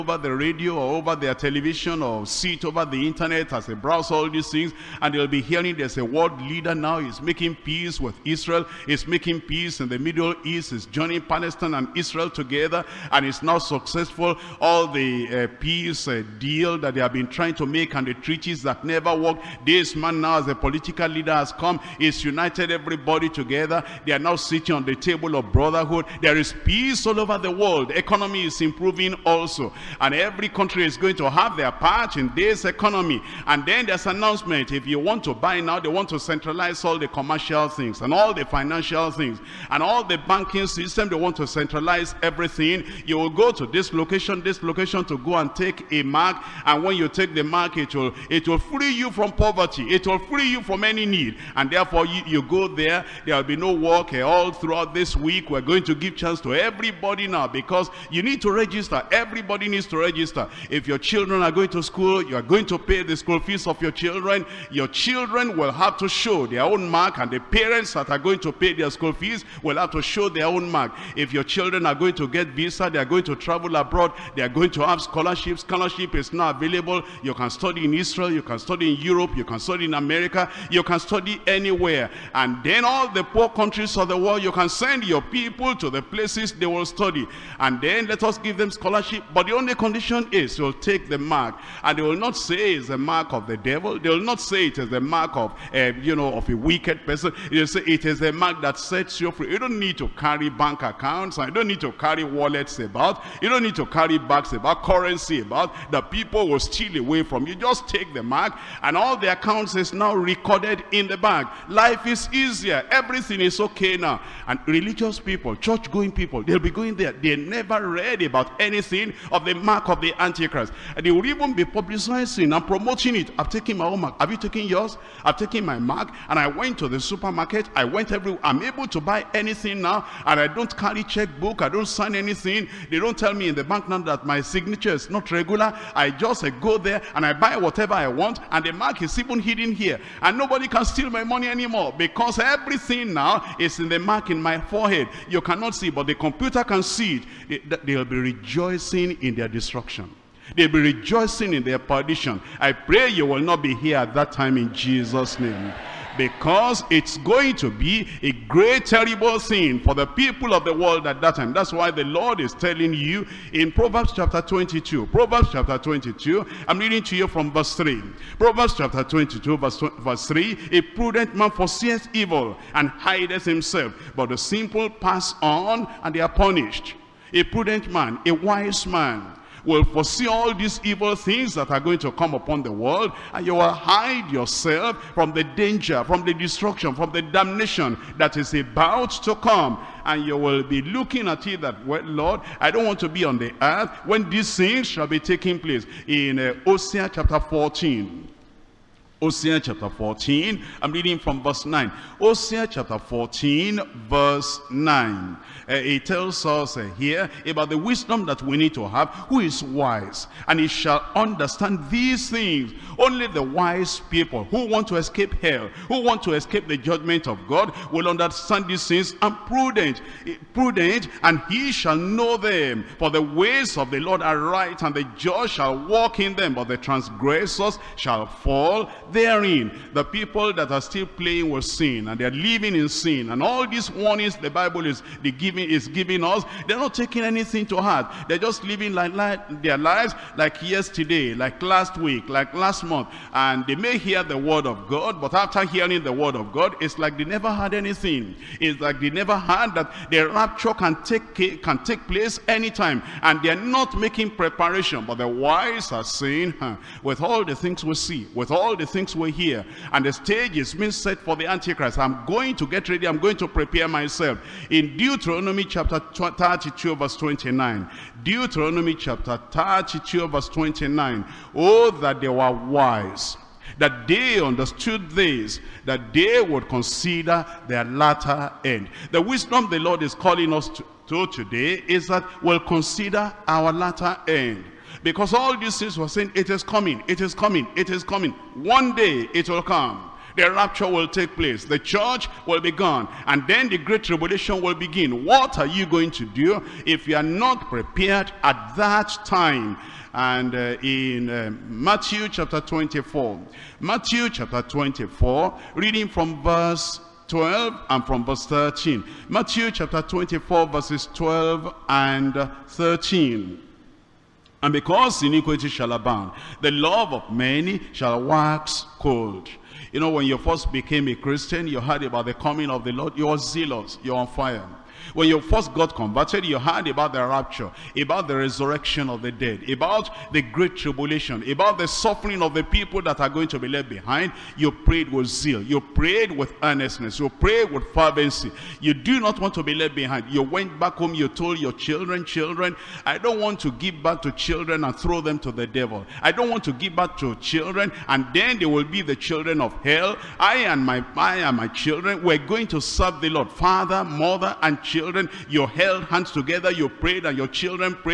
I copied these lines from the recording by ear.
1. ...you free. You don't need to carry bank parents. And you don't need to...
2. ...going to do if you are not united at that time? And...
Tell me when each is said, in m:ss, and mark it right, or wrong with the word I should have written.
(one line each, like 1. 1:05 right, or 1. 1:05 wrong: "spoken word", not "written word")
1. 1:39 wrong: "accounts", not "parents"
2. 4:55 wrong: "prepared", not "united".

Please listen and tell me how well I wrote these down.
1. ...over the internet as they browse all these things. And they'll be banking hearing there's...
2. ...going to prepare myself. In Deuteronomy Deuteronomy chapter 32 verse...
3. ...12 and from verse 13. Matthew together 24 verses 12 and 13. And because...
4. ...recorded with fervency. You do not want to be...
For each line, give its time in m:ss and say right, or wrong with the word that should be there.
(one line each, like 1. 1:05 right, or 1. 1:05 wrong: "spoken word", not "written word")
1. 0:02 wrong: "hearing", not "banking"
2. 4:23 right
3. 5:07 wrong: "chapter", not "together"
4. 5:37 wrong: "prayed", not "recorded".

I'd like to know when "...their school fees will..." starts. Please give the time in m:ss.
1:08.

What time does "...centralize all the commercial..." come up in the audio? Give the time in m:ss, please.
0:36.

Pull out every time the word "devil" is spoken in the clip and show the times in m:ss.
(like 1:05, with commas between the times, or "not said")
1:33, 5:45.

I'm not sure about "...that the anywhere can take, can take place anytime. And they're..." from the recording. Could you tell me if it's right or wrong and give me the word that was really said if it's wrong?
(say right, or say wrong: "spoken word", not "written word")
wrong: "rapture", not "anywhere".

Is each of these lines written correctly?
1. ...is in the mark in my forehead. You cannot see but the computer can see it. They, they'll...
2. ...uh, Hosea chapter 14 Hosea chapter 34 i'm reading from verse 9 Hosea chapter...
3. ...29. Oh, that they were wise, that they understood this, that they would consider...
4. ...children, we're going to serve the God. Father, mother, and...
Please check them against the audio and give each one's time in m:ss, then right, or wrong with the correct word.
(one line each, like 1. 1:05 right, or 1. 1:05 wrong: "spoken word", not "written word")
1. 2:23 right
2. 3:16 wrong: "14", not "34"
3. 4:30 right
4. 5:51 wrong: "Lord", not "God".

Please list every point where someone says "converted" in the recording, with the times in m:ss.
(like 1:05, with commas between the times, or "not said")
5:25.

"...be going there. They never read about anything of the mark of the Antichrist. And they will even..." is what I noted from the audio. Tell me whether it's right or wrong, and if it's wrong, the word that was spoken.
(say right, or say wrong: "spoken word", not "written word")
right.